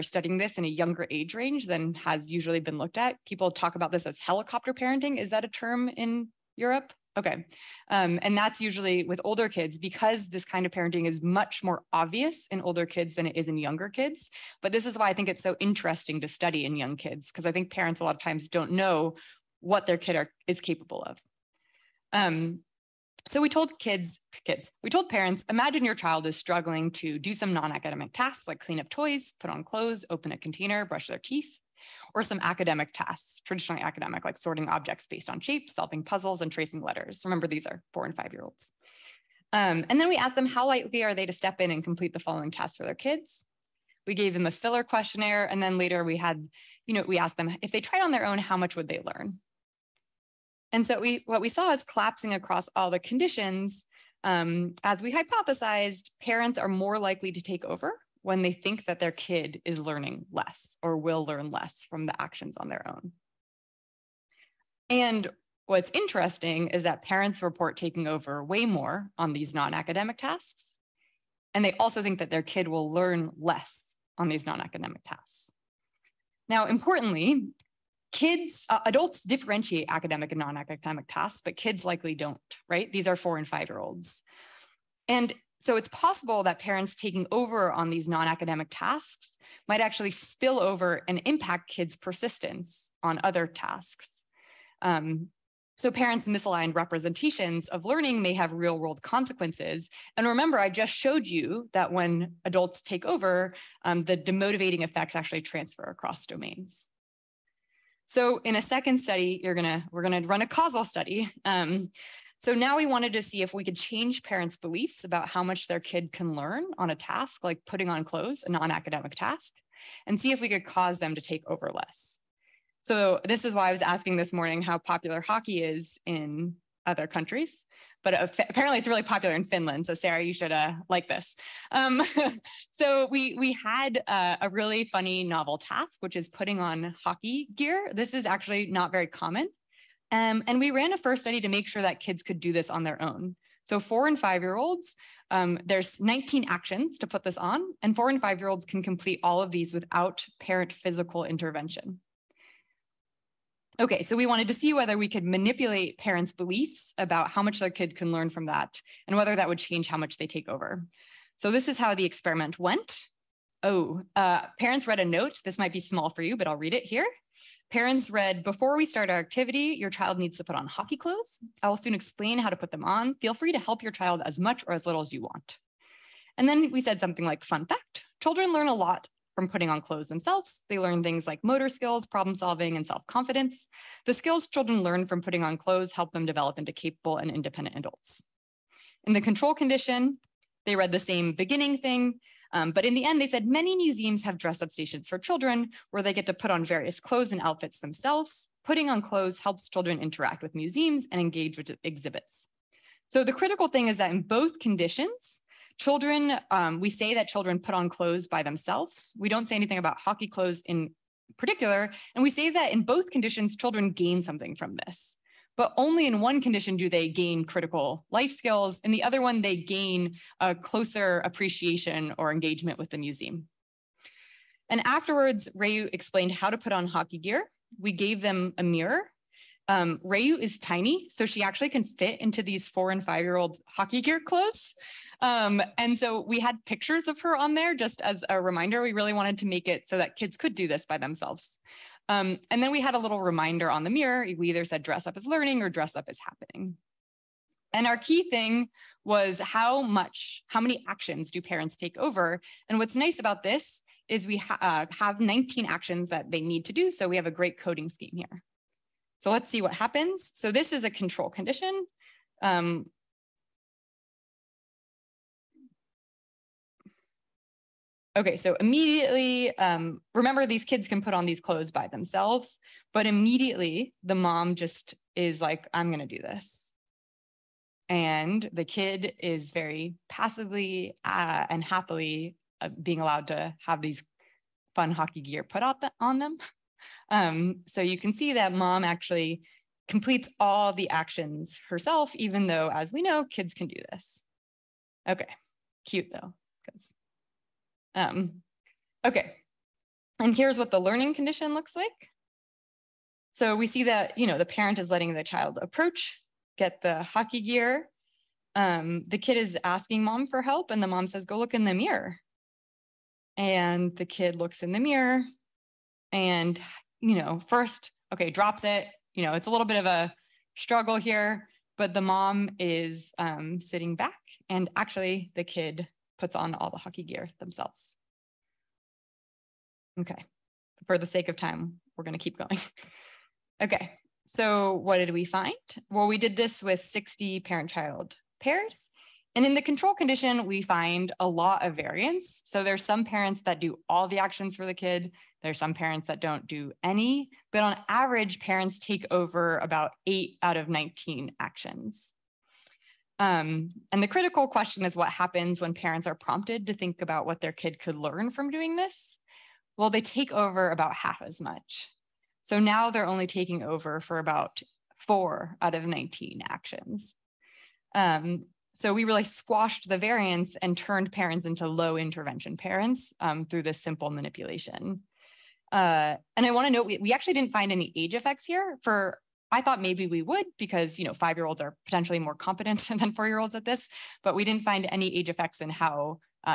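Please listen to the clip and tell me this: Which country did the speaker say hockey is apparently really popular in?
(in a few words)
Finland.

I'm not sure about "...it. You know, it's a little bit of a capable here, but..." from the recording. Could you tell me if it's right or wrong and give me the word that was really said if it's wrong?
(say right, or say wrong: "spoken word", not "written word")
wrong: "struggle", not "capable".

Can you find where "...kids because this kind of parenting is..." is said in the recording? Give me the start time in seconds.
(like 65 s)
9 s.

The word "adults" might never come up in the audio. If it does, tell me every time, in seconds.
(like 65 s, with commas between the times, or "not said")
78 s, 102 s, 187 s.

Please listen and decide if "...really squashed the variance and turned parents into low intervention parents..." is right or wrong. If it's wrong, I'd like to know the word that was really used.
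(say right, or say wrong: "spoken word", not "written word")
right.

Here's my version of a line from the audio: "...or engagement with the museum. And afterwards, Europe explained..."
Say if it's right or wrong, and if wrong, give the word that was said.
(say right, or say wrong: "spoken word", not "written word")
wrong: "Ray", not "Europe".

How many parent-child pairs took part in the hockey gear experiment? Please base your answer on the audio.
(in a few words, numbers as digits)
60.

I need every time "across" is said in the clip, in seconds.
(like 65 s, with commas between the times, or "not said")
52 s, 105 s.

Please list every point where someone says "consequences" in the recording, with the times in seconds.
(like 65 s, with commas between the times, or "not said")
99 s.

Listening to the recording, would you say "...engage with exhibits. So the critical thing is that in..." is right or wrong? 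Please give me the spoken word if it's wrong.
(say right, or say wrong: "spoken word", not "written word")
right.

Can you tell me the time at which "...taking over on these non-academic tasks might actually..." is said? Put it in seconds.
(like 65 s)
86 s.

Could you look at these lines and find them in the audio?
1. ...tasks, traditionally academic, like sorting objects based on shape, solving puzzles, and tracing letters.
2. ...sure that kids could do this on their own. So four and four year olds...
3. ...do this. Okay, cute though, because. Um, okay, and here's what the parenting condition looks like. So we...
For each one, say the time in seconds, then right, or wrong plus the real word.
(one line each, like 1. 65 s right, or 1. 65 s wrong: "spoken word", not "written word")
1. 32 s right
2. 141 s wrong: "five", not "four"
3. 293 s wrong: "learning", not "parenting".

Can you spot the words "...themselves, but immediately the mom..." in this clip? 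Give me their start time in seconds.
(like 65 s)
271 s.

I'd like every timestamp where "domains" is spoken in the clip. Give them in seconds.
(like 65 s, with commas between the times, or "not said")
106 s.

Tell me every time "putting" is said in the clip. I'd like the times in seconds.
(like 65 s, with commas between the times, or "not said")
117 s, 136 s, 179 s, 185 s, 198 s.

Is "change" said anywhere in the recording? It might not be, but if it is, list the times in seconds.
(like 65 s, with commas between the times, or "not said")
113 s, 159 s.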